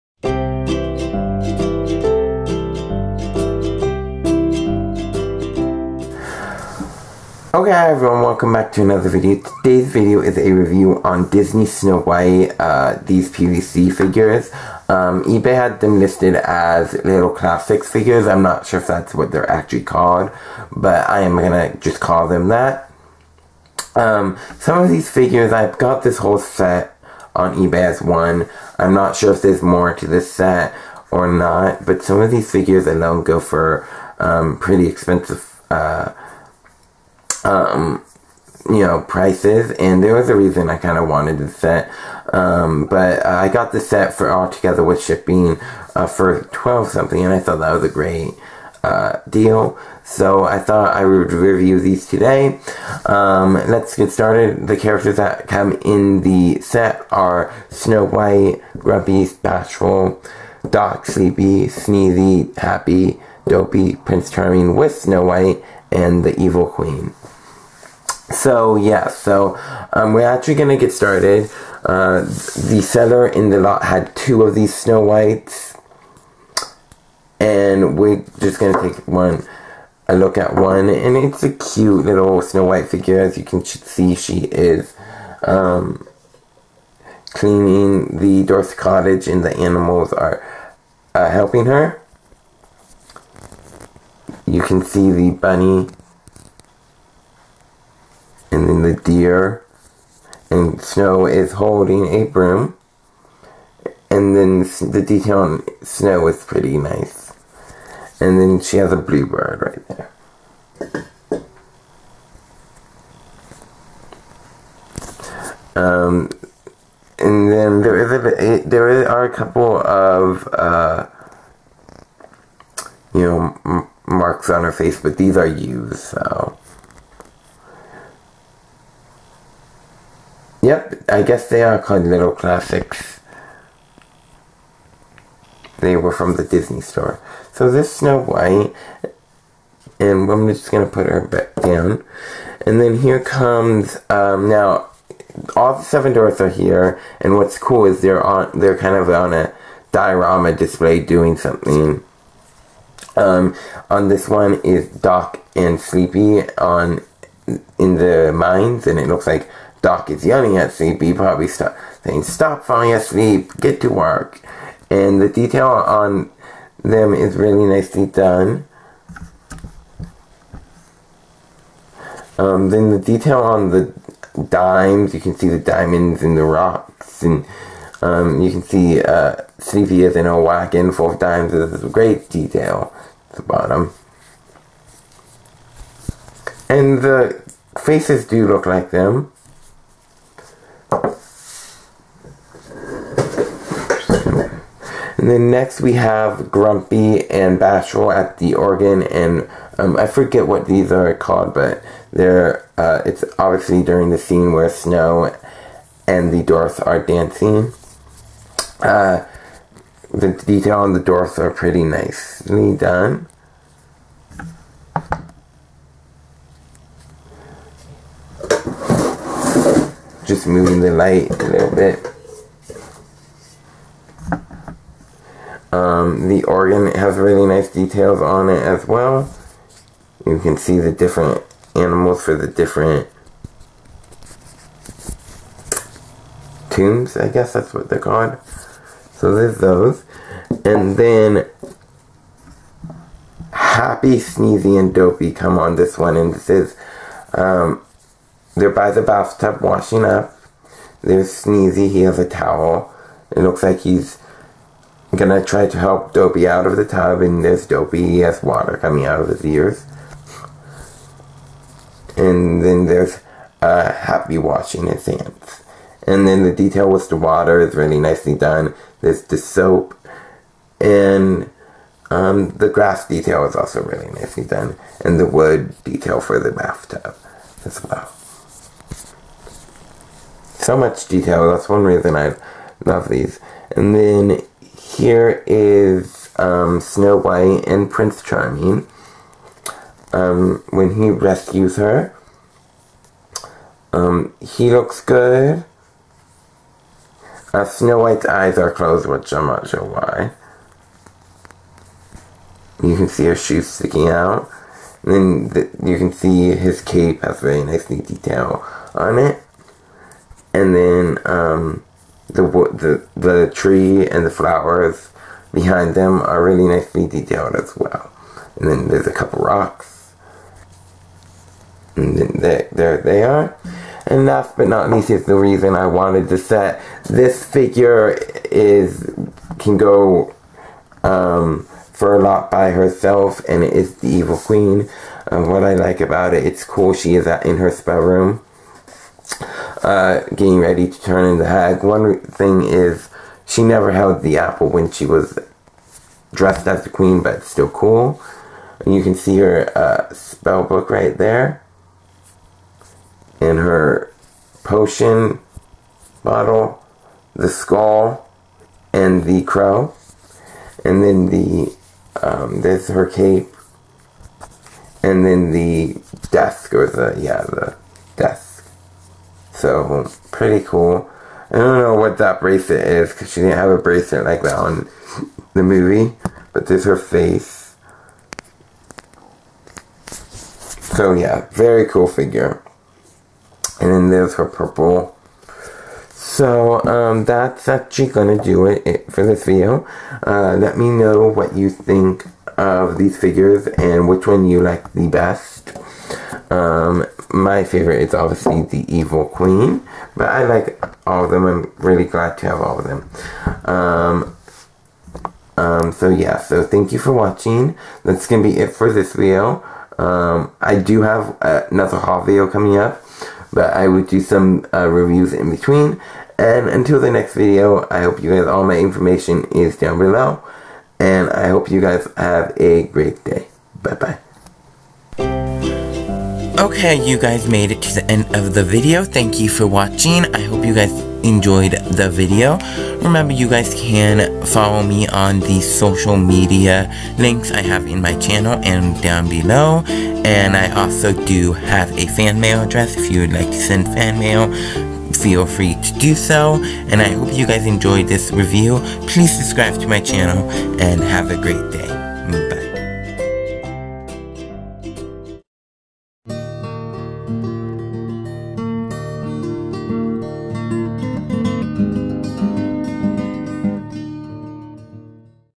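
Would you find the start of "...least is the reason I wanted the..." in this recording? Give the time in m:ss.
5:24.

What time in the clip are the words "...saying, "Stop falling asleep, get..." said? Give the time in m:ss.
2:42.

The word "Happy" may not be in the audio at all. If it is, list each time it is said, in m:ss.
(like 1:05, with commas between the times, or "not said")
1:02, 4:03, 4:23.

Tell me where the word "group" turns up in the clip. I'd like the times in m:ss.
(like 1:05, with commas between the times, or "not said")
not said.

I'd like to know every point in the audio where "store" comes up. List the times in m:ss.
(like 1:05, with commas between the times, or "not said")
2:16.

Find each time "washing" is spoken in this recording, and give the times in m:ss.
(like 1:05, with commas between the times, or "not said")
4:09, 4:24.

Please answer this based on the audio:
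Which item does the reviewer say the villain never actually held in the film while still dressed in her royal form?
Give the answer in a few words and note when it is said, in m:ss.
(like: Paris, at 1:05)
the apple, at 5:44.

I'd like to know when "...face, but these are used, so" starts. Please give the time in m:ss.
2:04.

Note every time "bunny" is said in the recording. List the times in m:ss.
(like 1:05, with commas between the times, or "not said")
1:35.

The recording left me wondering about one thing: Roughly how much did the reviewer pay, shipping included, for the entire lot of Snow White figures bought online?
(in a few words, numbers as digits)
12 something.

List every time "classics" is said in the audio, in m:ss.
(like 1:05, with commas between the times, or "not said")
0:17, 2:12.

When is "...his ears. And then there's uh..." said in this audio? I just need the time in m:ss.
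4:19.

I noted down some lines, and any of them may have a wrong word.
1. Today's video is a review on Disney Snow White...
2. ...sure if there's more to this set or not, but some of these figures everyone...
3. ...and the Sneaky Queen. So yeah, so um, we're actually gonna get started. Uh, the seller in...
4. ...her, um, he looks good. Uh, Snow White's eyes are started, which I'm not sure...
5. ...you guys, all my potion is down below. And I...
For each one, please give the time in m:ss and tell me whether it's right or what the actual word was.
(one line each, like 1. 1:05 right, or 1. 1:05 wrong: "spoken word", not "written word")
1. 0:09 right
2. 0:29 wrong: "alone", not "everyone"
3. 1:05 wrong: "Evil", not "Sneaky"
4. 4:51 wrong: "closed", not "started"
5. 6:58 wrong: "information", not "potion".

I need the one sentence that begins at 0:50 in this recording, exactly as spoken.
So I thought I would review these today.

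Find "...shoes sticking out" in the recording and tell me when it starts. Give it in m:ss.
5:03.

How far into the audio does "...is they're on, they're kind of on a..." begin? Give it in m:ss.
2:27.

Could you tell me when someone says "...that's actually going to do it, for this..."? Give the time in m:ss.
6:27.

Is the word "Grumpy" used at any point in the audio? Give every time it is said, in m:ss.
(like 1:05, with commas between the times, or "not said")
0:58, 3:16.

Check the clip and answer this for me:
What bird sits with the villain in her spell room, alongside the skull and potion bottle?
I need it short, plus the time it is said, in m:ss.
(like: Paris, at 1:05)
crow, at 5:59.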